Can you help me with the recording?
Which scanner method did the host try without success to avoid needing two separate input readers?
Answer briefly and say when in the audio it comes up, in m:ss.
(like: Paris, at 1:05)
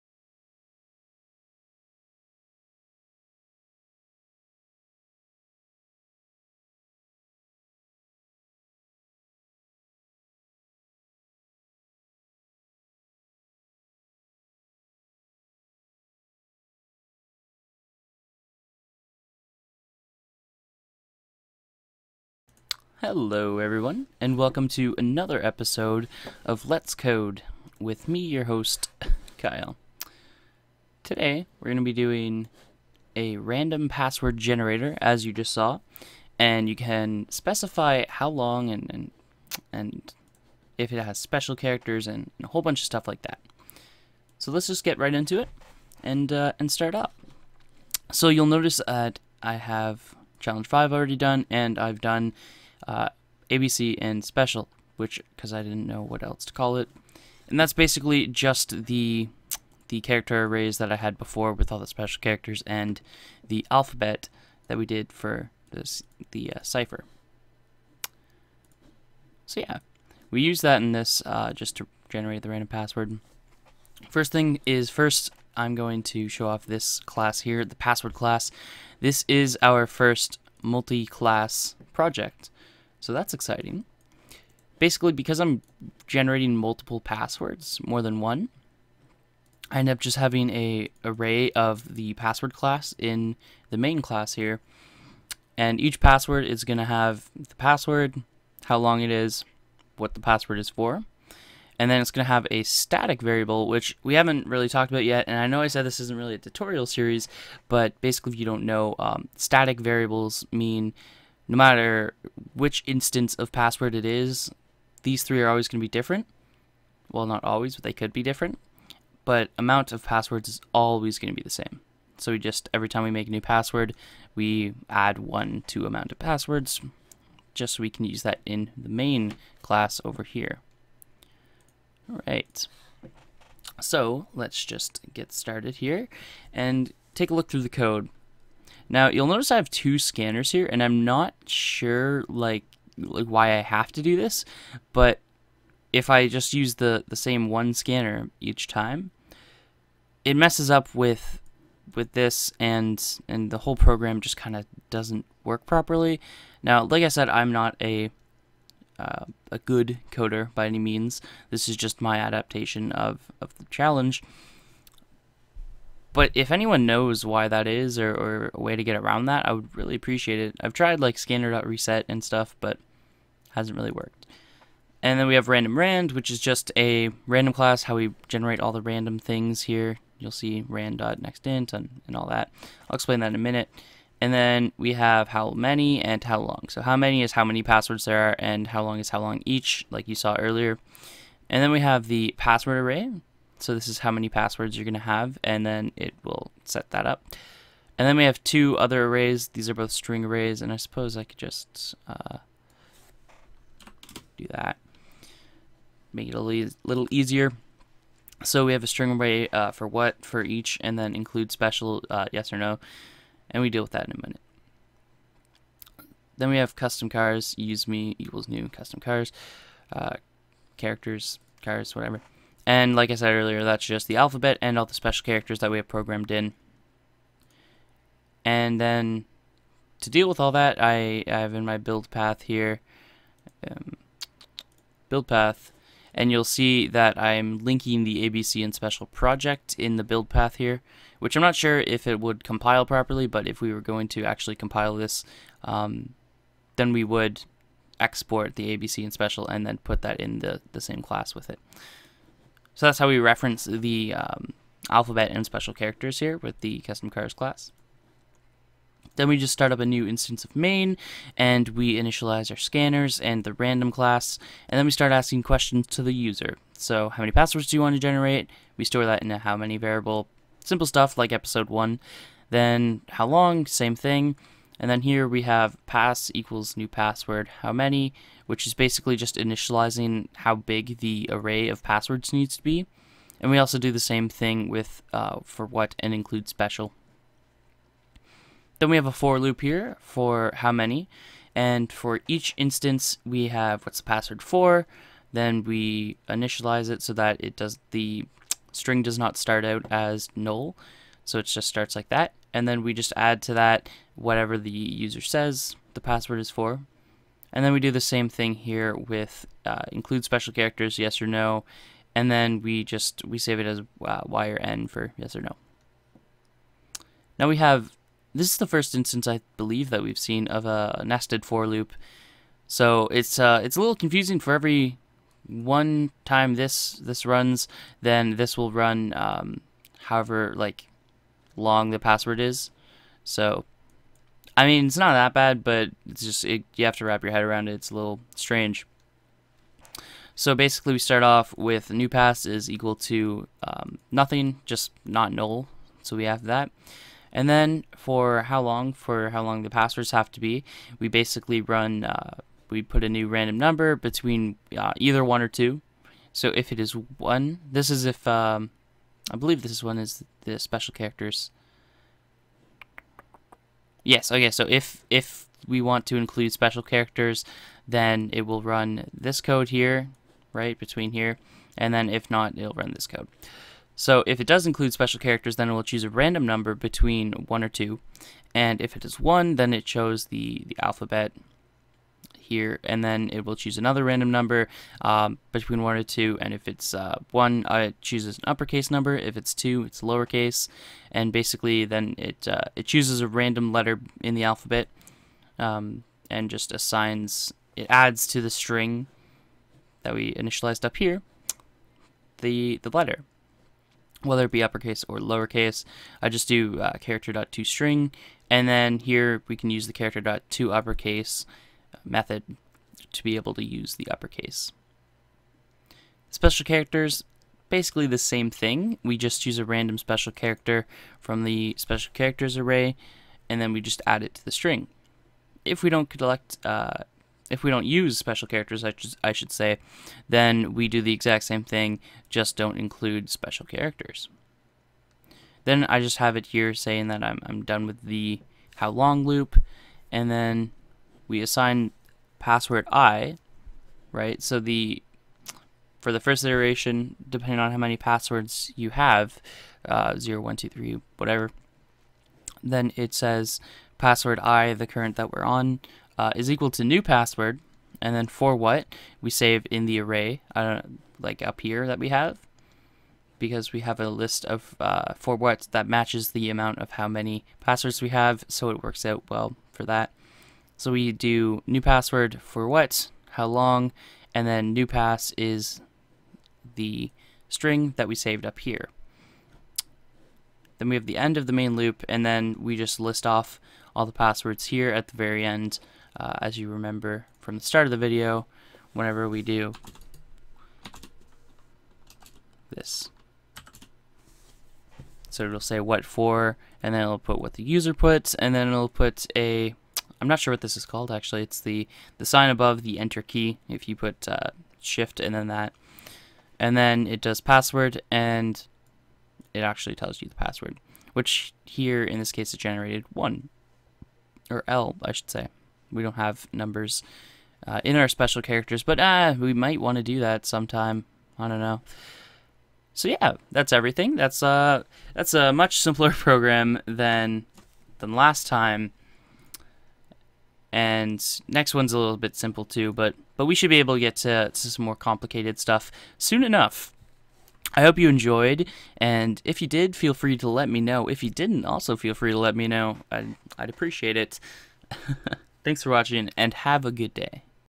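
scanner.reset, at 2:51.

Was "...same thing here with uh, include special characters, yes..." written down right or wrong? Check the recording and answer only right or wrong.
right.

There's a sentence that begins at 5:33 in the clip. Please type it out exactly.
So, I mean, it's not that bad, but it's just it, you have to wrap your head around it.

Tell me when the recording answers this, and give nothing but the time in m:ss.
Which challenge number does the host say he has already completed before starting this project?
0:50.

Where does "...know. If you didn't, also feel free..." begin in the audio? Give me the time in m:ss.
9:00.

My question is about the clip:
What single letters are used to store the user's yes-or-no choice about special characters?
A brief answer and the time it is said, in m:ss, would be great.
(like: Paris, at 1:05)
Y or N, at 5:14.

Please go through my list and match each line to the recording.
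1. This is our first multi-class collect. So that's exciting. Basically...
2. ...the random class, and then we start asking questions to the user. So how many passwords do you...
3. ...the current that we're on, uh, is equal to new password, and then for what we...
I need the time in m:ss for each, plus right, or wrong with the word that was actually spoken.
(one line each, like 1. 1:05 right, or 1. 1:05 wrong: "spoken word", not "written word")
1. 1:19 wrong: "project", not "collect"
2. 4:23 right
3. 7:34 right.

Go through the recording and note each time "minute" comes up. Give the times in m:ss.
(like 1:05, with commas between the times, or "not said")
3:03, 3:34.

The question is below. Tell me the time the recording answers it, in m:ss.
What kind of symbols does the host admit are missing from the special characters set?
8:36.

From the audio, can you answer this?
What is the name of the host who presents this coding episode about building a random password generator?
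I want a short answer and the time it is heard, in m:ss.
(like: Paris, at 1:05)
Kyle, at 0:29.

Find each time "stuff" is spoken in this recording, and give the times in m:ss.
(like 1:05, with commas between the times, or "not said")
0:42, 2:52, 4:30, 8:55.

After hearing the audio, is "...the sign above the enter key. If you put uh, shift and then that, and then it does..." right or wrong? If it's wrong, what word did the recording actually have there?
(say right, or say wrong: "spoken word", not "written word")
right.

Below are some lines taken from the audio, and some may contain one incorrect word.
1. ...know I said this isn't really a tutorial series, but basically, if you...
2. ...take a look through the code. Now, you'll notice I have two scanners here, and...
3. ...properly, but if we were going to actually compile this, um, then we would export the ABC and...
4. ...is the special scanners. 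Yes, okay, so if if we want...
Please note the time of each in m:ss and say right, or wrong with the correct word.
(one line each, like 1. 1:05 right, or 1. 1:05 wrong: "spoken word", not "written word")
1. 1:45 right
2. 2:17 right
3. 4:02 right
4. 5:59 wrong: "characters", not "scanners".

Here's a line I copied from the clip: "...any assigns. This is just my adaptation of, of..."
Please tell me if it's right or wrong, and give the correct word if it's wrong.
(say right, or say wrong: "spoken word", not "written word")
wrong: "means", not "assigns".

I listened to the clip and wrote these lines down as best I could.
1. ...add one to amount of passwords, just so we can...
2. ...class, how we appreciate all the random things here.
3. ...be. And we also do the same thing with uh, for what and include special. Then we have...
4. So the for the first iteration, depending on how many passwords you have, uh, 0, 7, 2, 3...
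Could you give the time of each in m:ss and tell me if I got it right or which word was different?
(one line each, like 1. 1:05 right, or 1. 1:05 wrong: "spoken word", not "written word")
1. 2:04 right
2. 2:57 wrong: "generate", not "appreciate"
3. 4:42 right
4. 7:24 wrong: "1", not "7".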